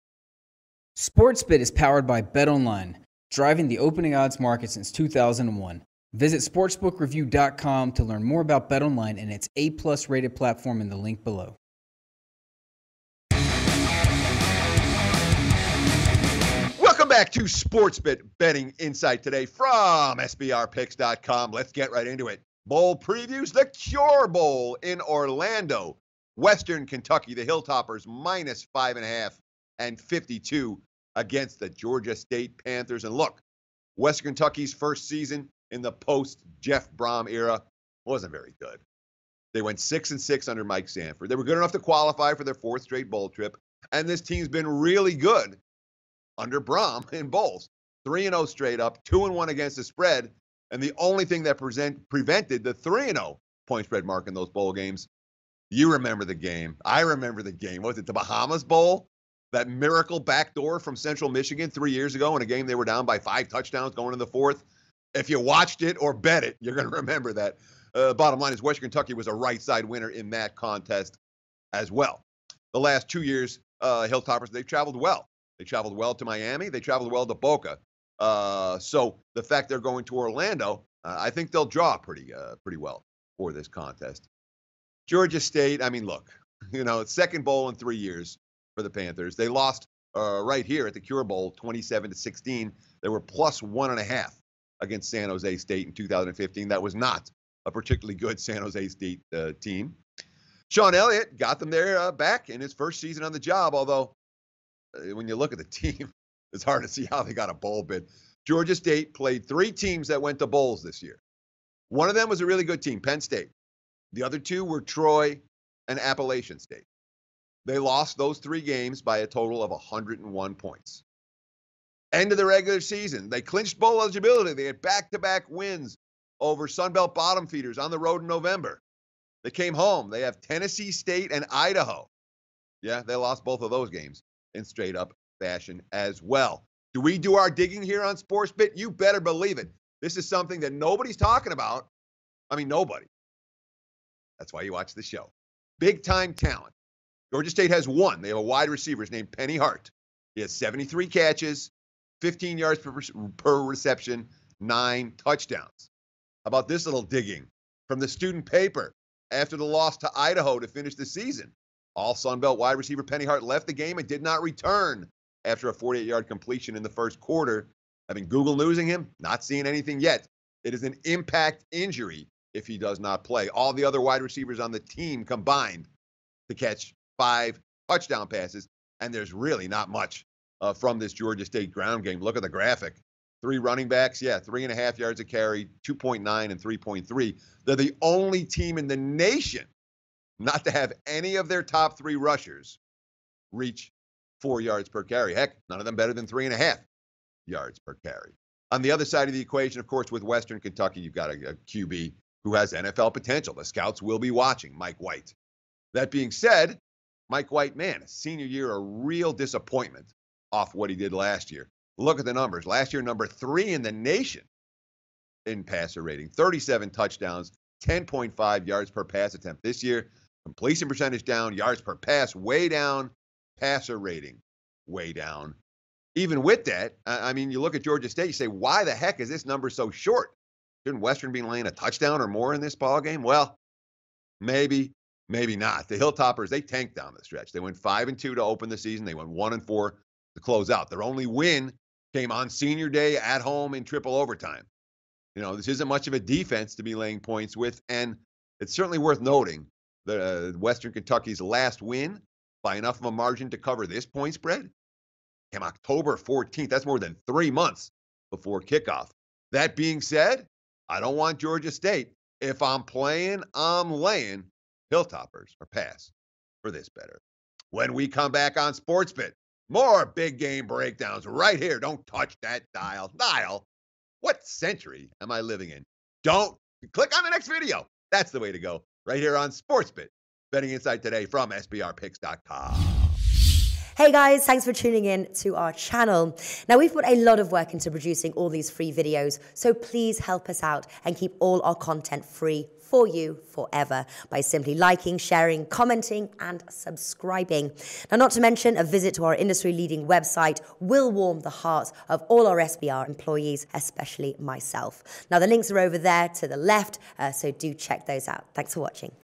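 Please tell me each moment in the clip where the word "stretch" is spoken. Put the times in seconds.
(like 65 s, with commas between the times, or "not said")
237 s.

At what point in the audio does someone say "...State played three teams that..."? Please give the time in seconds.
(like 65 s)
108 s.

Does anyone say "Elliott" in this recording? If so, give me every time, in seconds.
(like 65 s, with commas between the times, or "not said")
100 s.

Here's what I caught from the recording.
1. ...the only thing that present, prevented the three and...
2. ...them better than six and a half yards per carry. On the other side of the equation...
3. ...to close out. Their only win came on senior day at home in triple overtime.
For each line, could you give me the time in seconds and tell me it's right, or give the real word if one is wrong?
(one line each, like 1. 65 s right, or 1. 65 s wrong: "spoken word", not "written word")
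1. 50 s right
2. 195 s wrong: "three", not "six"
3. 240 s right.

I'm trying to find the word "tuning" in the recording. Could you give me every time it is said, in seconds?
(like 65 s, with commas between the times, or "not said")
284 s.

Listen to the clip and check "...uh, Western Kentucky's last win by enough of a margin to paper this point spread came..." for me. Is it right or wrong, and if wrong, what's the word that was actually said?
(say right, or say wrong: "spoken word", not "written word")
wrong: "cover", not "paper".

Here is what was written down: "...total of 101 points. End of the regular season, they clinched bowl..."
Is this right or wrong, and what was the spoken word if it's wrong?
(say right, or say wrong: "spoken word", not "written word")
right.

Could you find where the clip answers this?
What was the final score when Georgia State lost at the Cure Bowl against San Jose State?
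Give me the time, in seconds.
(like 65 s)
91 s.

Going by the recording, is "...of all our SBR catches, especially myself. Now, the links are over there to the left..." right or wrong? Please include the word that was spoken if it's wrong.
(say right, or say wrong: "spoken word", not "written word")
wrong: "employees", not "catches".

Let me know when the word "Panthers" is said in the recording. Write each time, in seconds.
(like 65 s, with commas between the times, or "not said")
32 s, 88 s.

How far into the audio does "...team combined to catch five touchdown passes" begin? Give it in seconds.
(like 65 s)
174 s.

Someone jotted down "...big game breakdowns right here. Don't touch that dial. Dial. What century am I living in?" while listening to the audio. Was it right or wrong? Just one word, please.
right.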